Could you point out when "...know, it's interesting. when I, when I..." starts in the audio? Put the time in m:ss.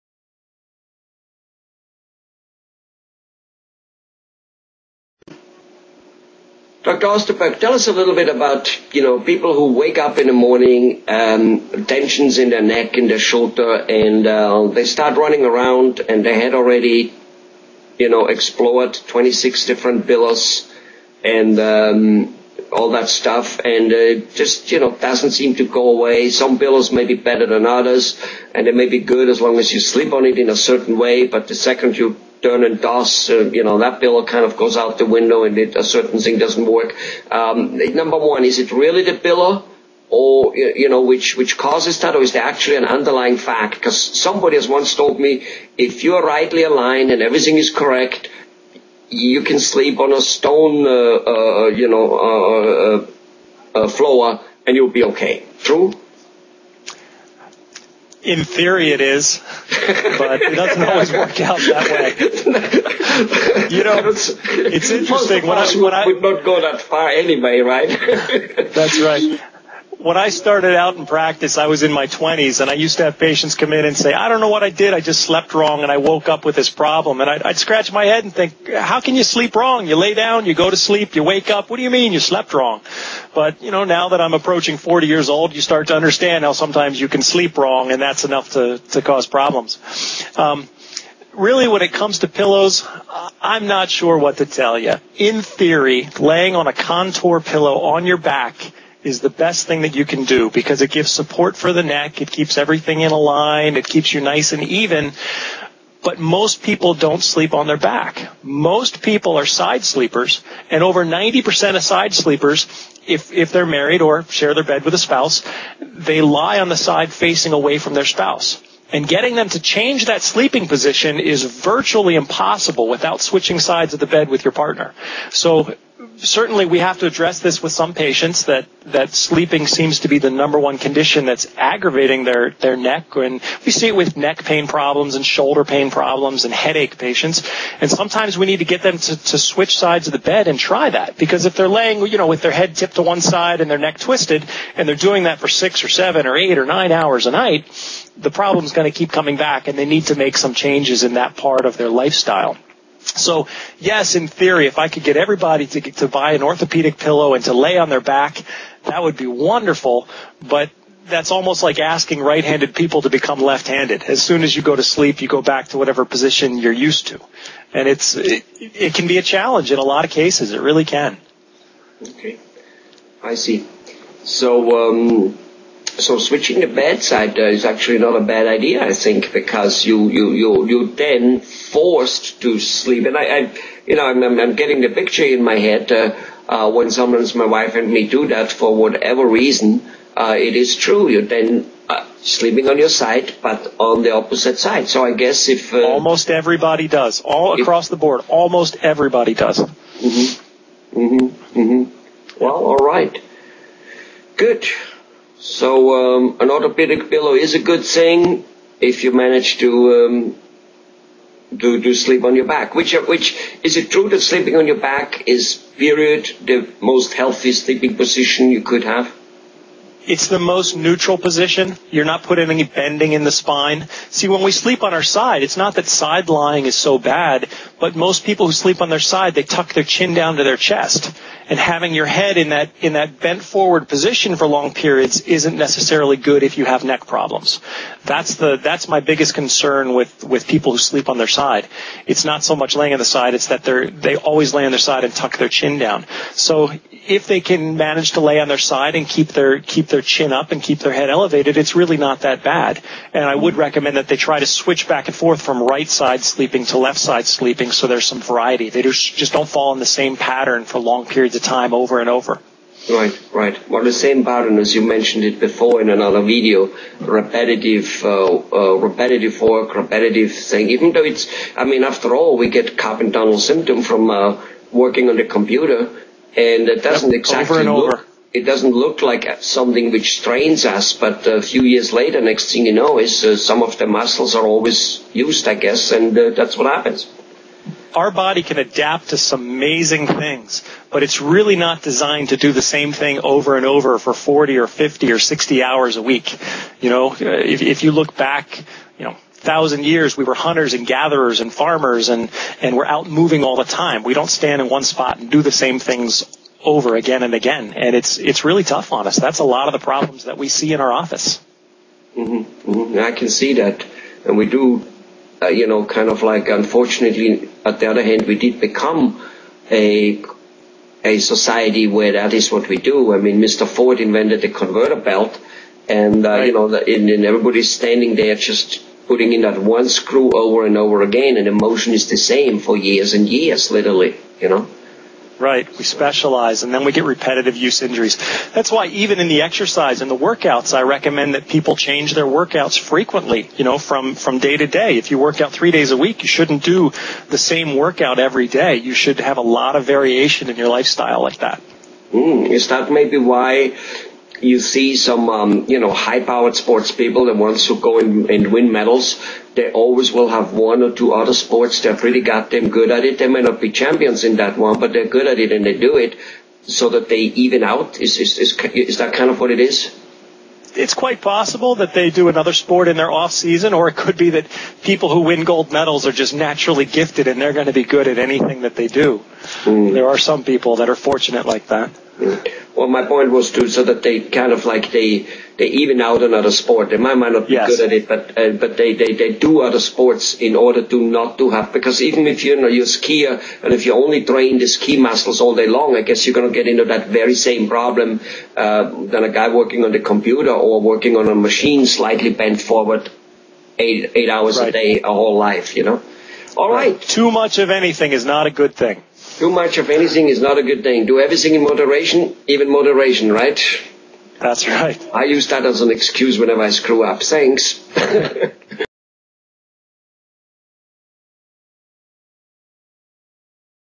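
1:03.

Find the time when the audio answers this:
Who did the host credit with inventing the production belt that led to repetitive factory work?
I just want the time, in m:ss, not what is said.
5:23.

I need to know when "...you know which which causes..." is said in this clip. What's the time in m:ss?
0:40.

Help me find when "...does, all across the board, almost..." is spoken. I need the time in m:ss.
3:16.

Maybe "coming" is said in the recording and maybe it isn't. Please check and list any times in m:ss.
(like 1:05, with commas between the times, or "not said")
2:29.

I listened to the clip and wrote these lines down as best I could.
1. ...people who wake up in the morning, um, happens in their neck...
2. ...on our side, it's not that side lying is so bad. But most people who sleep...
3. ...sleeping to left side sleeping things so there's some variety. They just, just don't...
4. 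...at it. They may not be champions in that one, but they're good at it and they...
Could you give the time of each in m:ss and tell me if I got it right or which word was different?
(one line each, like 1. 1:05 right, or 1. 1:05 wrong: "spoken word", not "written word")
1. 0:09 wrong: "tensions", not "happens"
2. 3:44 right
3. 4:16 right
4. 6:02 right.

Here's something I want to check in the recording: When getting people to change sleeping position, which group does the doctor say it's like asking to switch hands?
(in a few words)
right-handed people.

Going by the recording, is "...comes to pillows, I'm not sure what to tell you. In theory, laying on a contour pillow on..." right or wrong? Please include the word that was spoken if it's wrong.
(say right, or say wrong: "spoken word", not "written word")
right.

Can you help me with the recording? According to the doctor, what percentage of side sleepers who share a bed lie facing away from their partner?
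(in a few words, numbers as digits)
over 90%.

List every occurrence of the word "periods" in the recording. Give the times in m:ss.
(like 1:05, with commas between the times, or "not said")
3:35, 3:54, 4:21.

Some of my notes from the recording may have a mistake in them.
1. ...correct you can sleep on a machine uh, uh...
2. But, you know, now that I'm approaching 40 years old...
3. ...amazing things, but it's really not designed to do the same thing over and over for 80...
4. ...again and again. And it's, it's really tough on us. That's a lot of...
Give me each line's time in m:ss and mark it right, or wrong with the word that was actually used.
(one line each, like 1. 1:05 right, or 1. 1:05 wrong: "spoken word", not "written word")
1. 0:47 wrong: "stone", not "machine"
2. 1:23 right
3. 4:49 wrong: "40", not "80"
4. 5:06 right.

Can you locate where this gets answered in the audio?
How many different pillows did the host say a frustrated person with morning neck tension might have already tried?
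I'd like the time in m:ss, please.
0:19.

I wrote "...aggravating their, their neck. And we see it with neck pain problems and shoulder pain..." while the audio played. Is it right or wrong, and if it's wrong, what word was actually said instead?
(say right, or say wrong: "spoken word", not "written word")
right.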